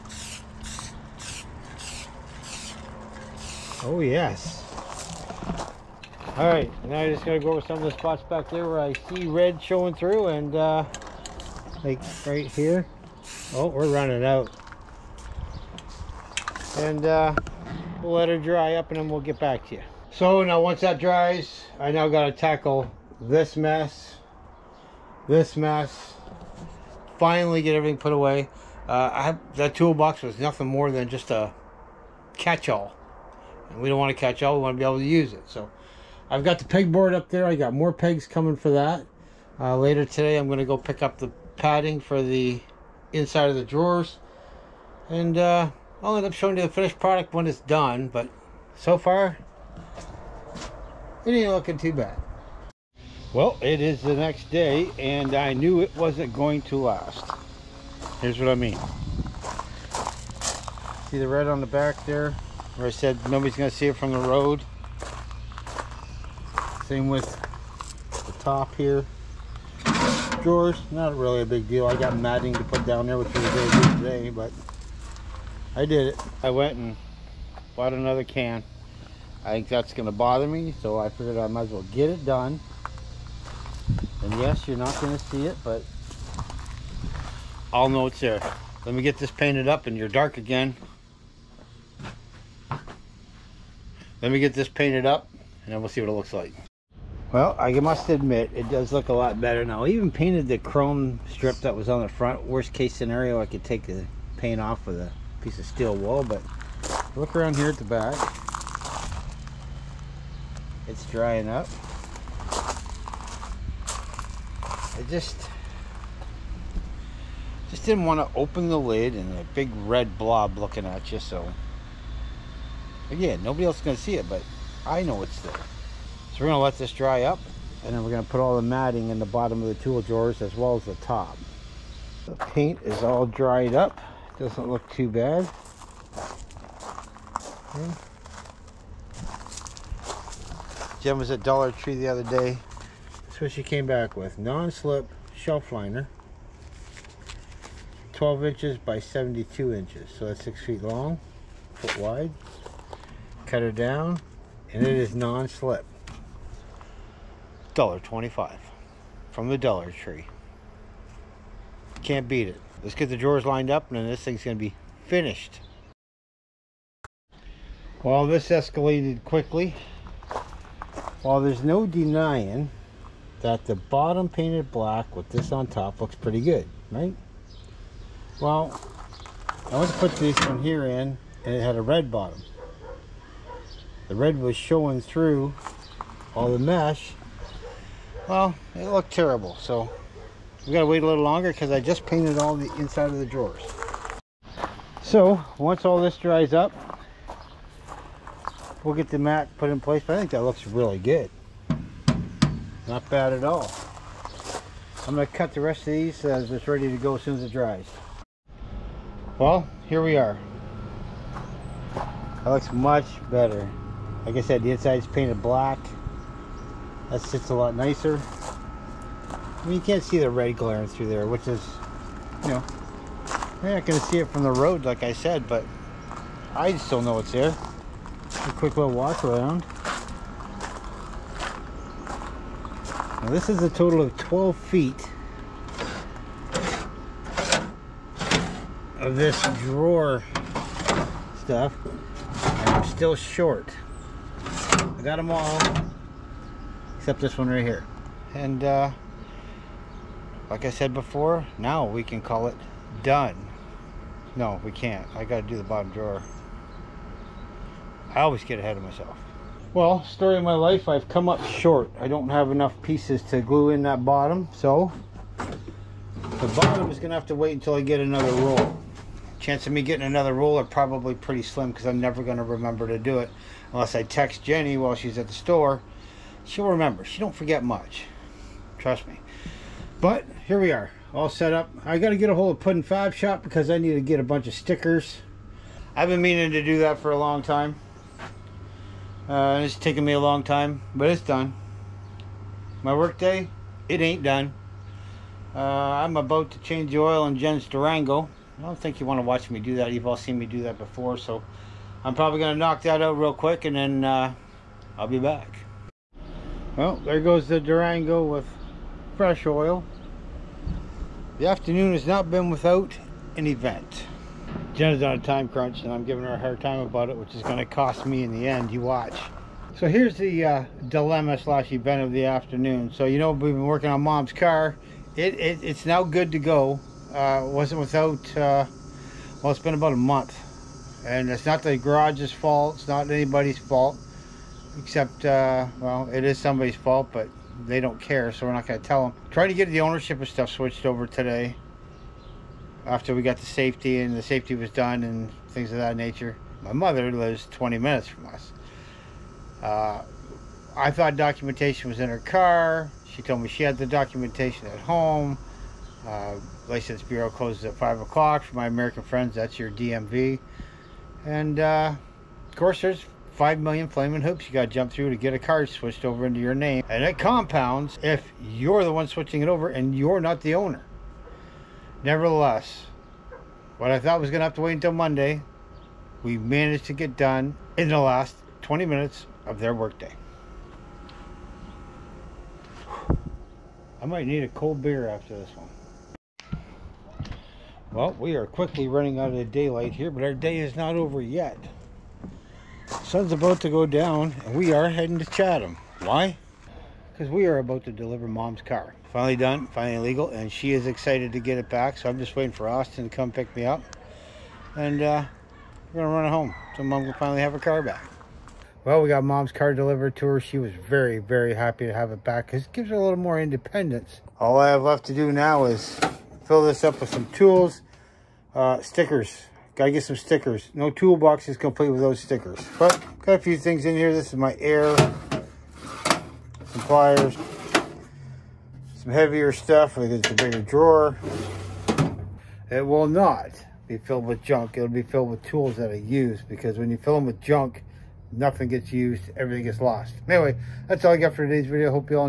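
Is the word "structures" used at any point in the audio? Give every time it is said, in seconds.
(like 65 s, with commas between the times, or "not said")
not said.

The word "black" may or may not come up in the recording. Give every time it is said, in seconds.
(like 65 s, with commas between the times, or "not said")
174 s, 215 s.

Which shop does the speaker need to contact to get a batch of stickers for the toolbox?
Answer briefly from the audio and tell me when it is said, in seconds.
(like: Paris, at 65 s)
Puddin Fab Shop, at 282 s.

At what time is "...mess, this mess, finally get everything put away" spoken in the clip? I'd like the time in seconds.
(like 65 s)
23 s.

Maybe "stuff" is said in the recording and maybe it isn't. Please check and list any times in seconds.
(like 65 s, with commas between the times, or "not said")
241 s, 340 s, 429 s.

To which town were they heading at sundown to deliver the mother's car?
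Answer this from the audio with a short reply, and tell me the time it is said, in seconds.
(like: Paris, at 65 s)
Chatham, at 395 s.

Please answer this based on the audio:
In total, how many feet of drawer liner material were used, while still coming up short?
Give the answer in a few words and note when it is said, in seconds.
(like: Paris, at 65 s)
12 feet, at 234 s.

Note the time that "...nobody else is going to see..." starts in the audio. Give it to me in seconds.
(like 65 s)
123 s.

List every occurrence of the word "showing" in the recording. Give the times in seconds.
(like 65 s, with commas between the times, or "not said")
9 s, 46 s, 184 s.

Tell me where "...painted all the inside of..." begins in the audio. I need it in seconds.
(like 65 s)
192 s.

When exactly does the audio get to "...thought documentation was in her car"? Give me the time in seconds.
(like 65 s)
350 s.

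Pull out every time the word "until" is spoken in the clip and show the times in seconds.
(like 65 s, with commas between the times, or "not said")
267 s, 374 s.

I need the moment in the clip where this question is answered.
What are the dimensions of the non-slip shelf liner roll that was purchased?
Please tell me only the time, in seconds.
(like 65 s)
148 s.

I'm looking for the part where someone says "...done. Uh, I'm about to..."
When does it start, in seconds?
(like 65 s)
294 s.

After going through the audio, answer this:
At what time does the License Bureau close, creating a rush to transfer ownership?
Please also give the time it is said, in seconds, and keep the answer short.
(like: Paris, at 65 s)
5 o'clock, at 357 s.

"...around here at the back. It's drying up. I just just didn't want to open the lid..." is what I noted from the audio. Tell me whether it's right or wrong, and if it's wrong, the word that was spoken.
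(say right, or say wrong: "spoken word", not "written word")
right.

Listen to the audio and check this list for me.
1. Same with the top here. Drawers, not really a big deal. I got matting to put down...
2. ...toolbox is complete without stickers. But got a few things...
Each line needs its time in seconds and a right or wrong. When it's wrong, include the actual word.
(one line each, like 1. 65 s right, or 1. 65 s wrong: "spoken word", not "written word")
1. 66 s right
2. 420 s right.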